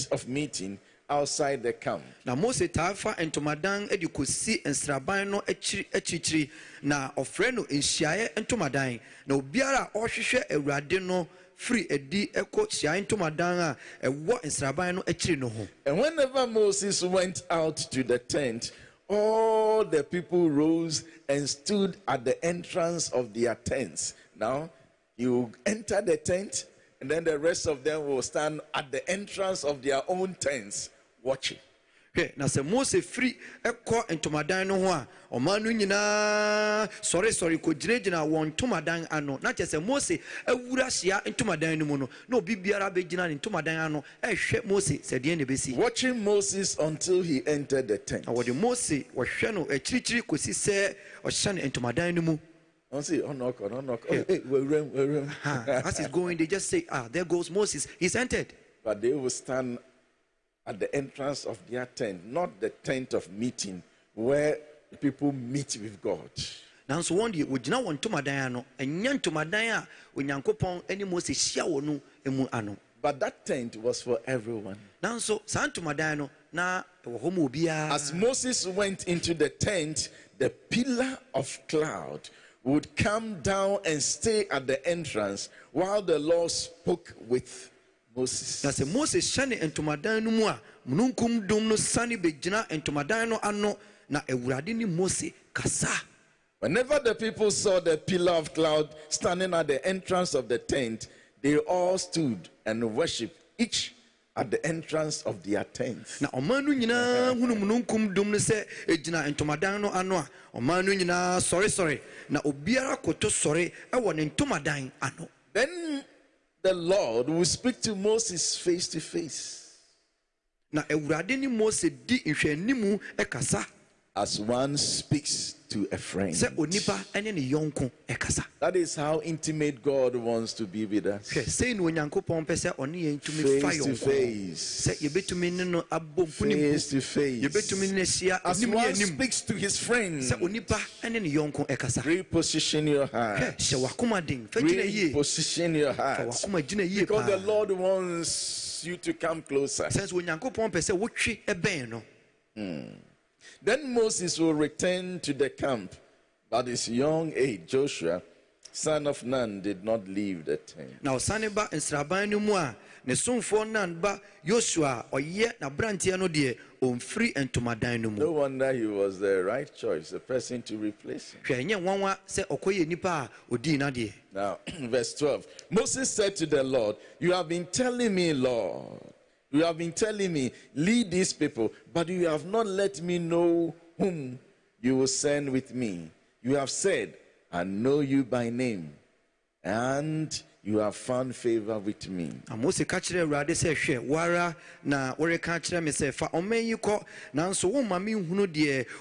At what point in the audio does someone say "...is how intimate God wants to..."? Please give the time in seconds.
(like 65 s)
128 s.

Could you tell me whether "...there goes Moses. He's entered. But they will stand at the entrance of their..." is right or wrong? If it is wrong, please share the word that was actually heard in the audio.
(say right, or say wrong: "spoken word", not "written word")
right.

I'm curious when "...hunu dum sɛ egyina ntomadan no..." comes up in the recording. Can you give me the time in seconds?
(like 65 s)
107 s.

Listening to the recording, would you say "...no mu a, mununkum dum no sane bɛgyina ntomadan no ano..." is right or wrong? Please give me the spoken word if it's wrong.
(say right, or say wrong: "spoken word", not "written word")
right.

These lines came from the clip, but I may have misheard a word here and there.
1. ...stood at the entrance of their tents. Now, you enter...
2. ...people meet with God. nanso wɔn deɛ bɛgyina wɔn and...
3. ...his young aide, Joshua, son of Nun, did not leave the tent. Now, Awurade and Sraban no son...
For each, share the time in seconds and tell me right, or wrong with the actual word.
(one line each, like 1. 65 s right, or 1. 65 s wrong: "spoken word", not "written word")
1. 21 s right
2. 65 s wrong: "wɔgyina", not "bɛgyina"
3. 156 s wrong: "Saniba", not "Awurade".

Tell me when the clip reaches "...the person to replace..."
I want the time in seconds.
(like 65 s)
170 s.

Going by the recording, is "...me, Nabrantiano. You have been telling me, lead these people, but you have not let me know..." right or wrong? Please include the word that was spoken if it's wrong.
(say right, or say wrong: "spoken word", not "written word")
wrong: "Lord", not "Nabrantiano".